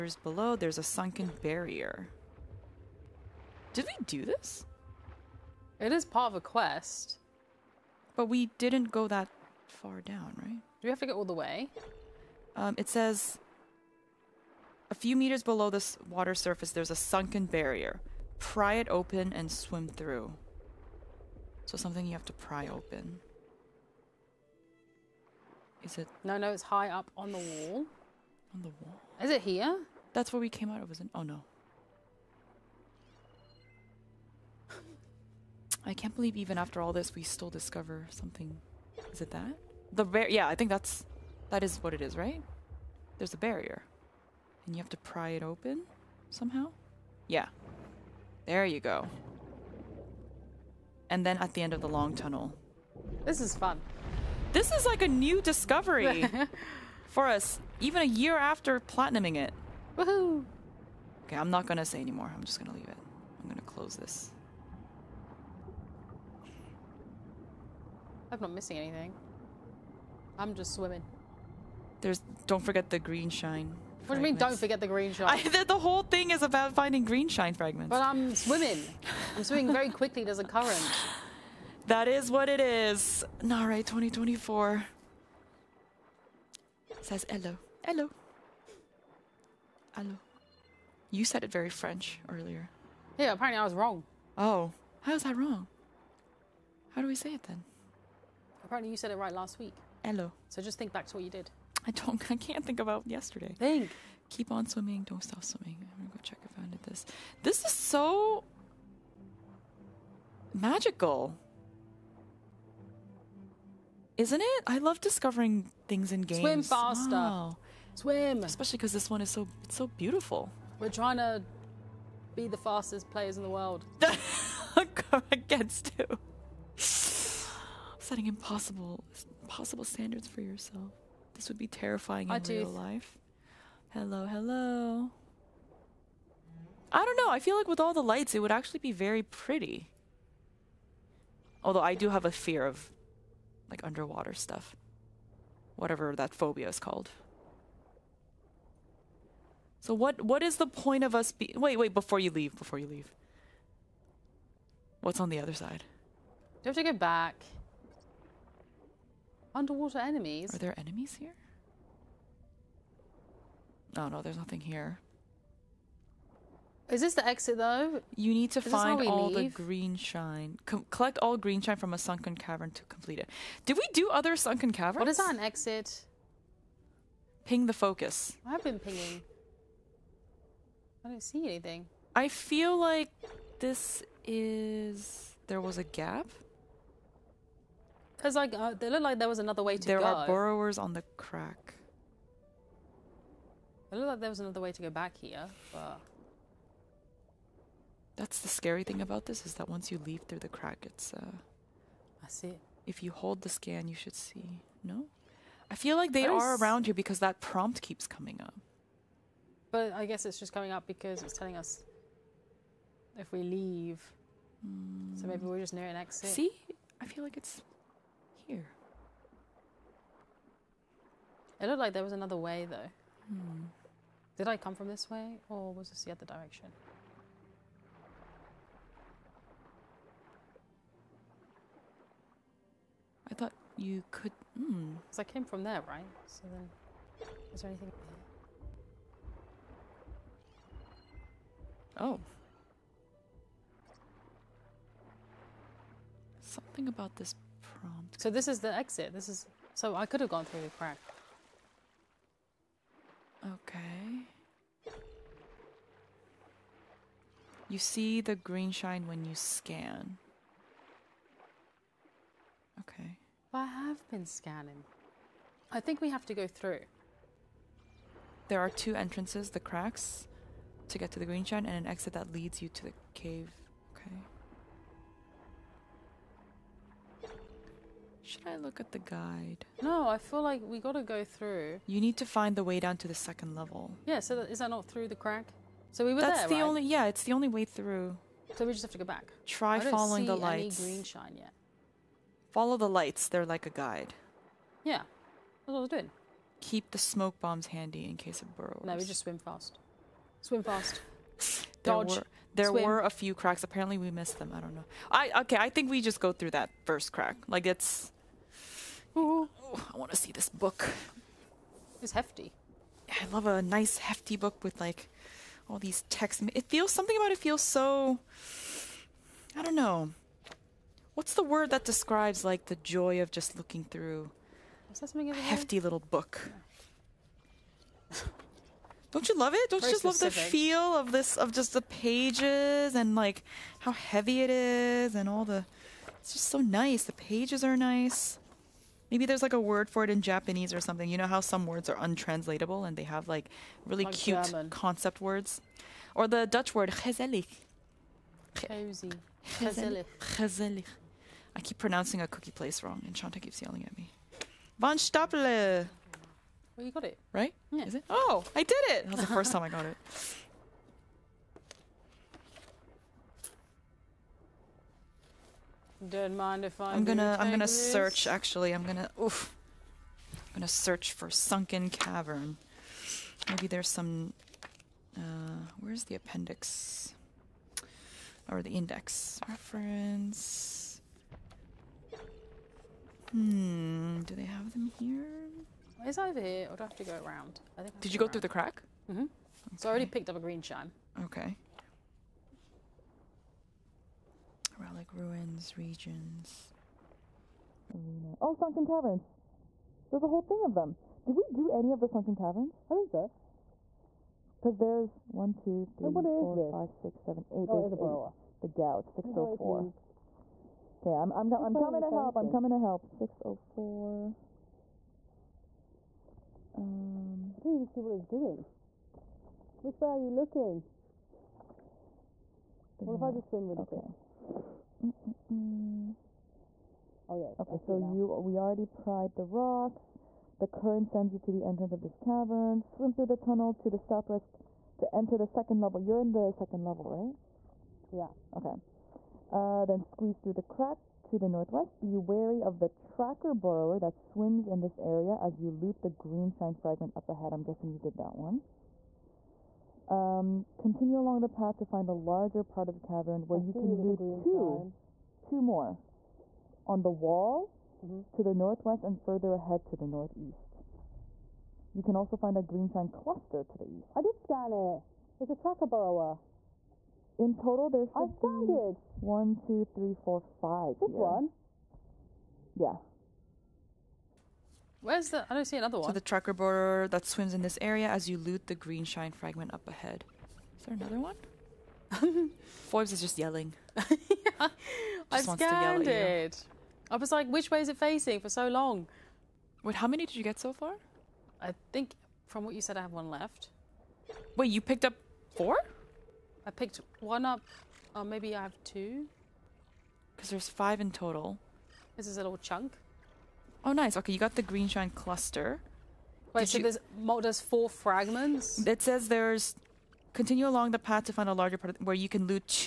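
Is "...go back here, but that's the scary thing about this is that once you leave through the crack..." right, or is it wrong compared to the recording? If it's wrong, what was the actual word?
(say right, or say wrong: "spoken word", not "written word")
right.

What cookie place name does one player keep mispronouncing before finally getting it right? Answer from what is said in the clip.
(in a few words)
Van Stapele.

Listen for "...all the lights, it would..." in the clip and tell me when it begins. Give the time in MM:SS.
02:17.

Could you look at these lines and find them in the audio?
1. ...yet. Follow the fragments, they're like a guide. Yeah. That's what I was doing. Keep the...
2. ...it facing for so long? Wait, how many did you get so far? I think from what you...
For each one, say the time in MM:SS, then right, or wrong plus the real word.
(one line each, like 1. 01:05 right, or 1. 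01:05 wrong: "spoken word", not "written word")
1. 04:51 wrong: "lights", not "fragments"
2. 08:07 right.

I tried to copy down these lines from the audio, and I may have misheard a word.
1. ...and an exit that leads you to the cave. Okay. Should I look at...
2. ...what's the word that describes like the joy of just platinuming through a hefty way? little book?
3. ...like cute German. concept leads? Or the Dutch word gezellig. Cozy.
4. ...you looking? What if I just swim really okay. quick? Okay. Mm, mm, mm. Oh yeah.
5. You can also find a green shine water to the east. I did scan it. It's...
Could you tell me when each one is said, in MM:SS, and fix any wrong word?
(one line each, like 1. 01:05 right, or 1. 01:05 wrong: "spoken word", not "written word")
1. 04:31 right
2. 05:21 wrong: "looking", not "platinuming"
3. 05:44 wrong: "words", not "leads"
4. 07:00 right
5. 07:41 wrong: "cluster", not "water".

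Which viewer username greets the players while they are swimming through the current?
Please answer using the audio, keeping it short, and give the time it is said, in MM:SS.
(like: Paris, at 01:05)
Nare 2024, at 01:23.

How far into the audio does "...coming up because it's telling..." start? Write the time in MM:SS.
03:30.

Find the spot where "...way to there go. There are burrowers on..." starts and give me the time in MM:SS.
03:09.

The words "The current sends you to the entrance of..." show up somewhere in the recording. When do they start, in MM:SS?
07:10.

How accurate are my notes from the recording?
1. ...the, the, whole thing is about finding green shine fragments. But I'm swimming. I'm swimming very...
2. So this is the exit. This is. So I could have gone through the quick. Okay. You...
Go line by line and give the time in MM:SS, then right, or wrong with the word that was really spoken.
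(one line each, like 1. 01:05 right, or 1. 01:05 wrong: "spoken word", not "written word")
1. 01:15 right
2. 04:08 wrong: "crack", not "quick".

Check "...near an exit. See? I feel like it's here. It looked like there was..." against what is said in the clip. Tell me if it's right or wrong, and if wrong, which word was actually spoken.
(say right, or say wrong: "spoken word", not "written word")
right.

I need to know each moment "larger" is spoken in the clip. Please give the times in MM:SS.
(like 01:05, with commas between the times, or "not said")
07:32, 08:31.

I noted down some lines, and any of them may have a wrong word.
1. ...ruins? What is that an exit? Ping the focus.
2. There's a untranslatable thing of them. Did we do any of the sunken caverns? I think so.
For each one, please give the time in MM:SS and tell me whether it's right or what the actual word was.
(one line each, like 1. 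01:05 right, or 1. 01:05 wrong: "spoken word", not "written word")
1. 02:54 wrong: "caverns", not "ruins"
2. 06:40 wrong: "whole", not "untranslatable".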